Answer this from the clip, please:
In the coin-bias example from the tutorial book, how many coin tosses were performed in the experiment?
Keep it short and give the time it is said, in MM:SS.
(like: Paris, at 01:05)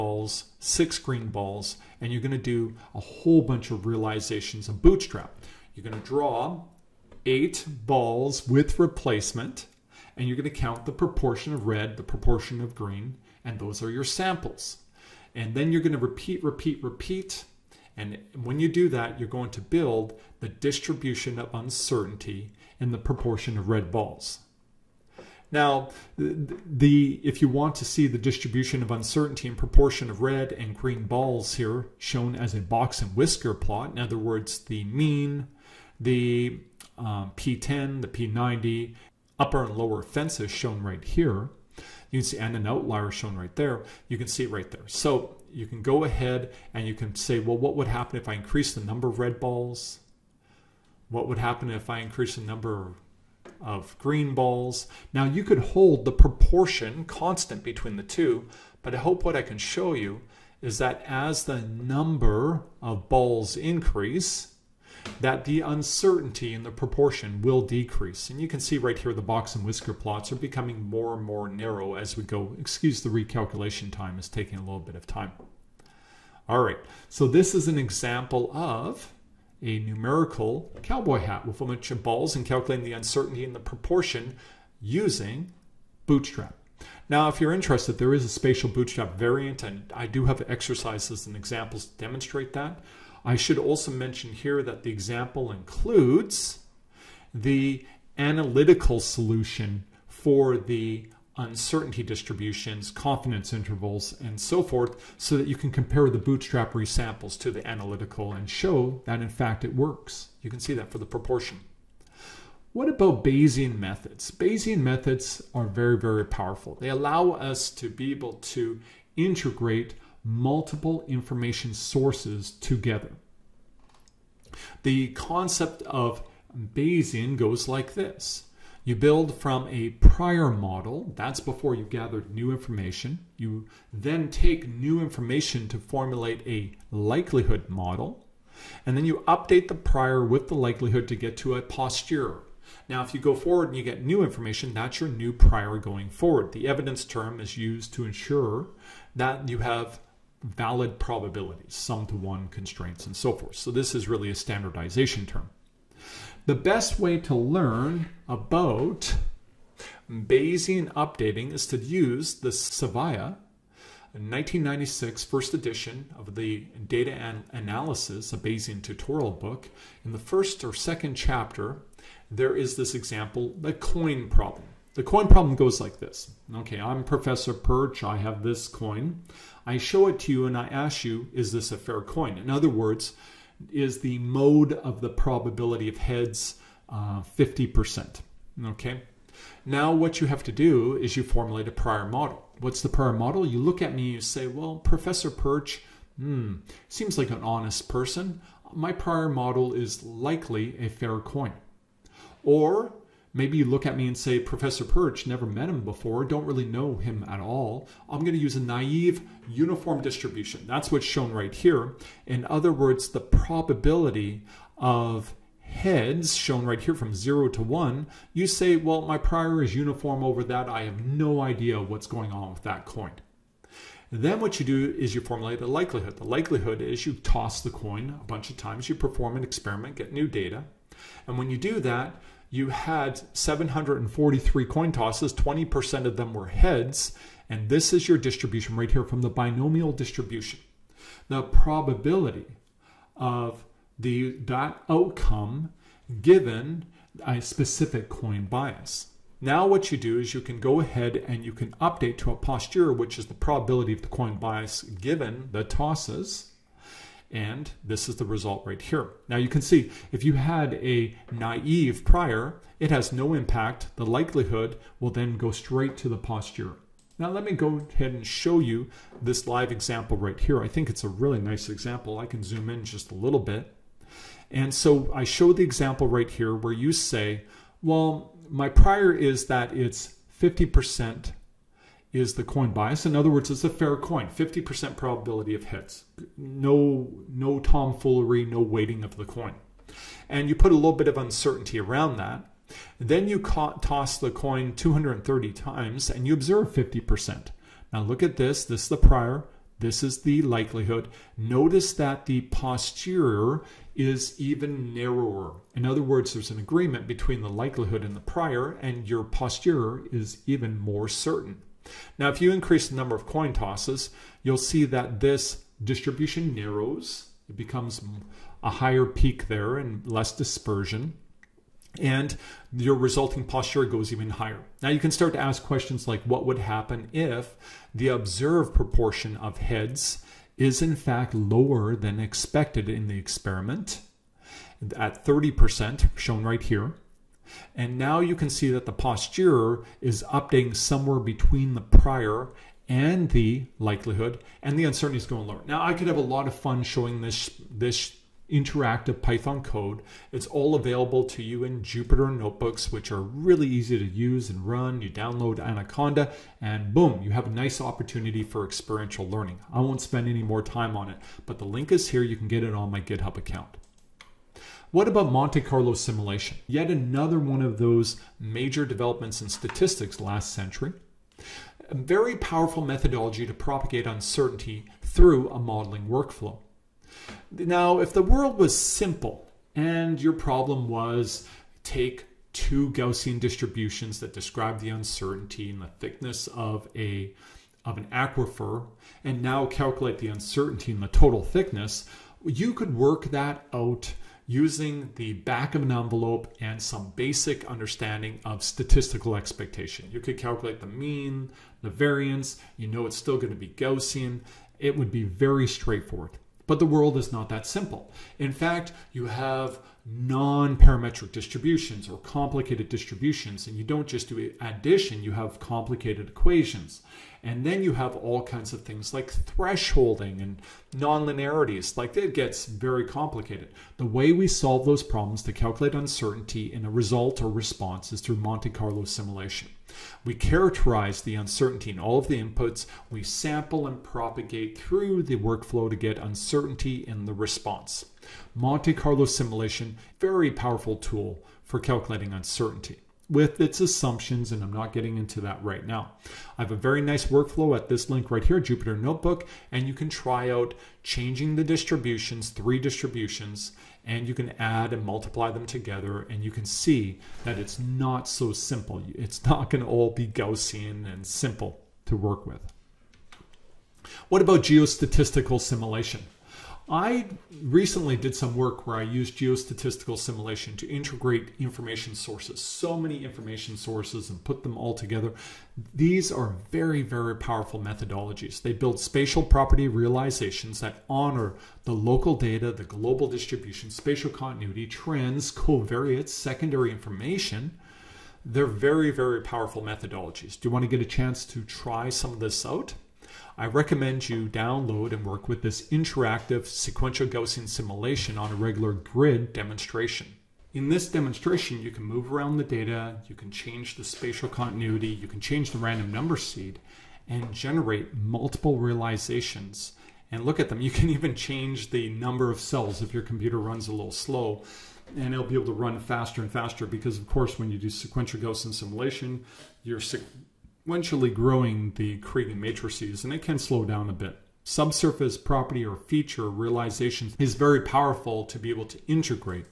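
743, at 03:53.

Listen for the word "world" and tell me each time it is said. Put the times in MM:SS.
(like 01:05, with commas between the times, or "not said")
06:18, 06:46.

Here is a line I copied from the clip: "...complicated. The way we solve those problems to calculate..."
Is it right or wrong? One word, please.
right.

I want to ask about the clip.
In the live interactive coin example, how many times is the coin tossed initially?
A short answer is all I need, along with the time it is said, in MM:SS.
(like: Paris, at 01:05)
230, at 04:54.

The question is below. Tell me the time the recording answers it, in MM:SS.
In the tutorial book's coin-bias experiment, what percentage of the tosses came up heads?
03:55.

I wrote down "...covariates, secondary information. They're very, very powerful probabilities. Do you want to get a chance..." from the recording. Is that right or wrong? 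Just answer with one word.
wrong.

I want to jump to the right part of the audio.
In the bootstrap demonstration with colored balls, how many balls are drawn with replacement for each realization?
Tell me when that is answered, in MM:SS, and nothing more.
00:07.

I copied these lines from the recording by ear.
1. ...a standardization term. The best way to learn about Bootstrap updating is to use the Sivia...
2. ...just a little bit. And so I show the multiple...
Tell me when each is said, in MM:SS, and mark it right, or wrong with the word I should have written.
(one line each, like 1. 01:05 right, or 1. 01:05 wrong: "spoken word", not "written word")
1. 02:34 wrong: "Bayesian", not "Bootstrap"
2. 04:32 wrong: "example", not "multiple".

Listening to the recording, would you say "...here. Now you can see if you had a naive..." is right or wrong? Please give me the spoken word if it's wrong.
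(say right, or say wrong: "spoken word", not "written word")
right.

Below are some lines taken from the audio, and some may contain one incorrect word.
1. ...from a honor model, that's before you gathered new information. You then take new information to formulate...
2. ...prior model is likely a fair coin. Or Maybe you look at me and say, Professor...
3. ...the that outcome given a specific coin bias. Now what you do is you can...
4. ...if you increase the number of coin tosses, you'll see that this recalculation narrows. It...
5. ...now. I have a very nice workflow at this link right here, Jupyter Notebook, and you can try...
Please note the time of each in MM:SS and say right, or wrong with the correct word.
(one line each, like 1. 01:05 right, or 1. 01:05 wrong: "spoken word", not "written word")
1. 02:09 wrong: "prior", not "honor"
2. 03:18 right
3. 04:03 right
4. 05:12 wrong: "distribution", not "recalculation"
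5. 07:25 right.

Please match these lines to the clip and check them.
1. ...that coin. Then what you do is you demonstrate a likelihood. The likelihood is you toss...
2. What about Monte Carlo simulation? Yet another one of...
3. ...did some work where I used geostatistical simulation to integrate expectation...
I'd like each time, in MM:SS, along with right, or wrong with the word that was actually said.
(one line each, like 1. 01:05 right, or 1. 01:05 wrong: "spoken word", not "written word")
1. 03:42 wrong: "formulate", not "demonstrate"
2. 06:04 right
3. 07:48 wrong: "information", not "expectation".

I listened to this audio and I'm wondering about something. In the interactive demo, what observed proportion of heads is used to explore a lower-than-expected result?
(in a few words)
30%.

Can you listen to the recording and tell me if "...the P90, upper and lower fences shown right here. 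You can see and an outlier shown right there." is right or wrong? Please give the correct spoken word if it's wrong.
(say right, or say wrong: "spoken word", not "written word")
right.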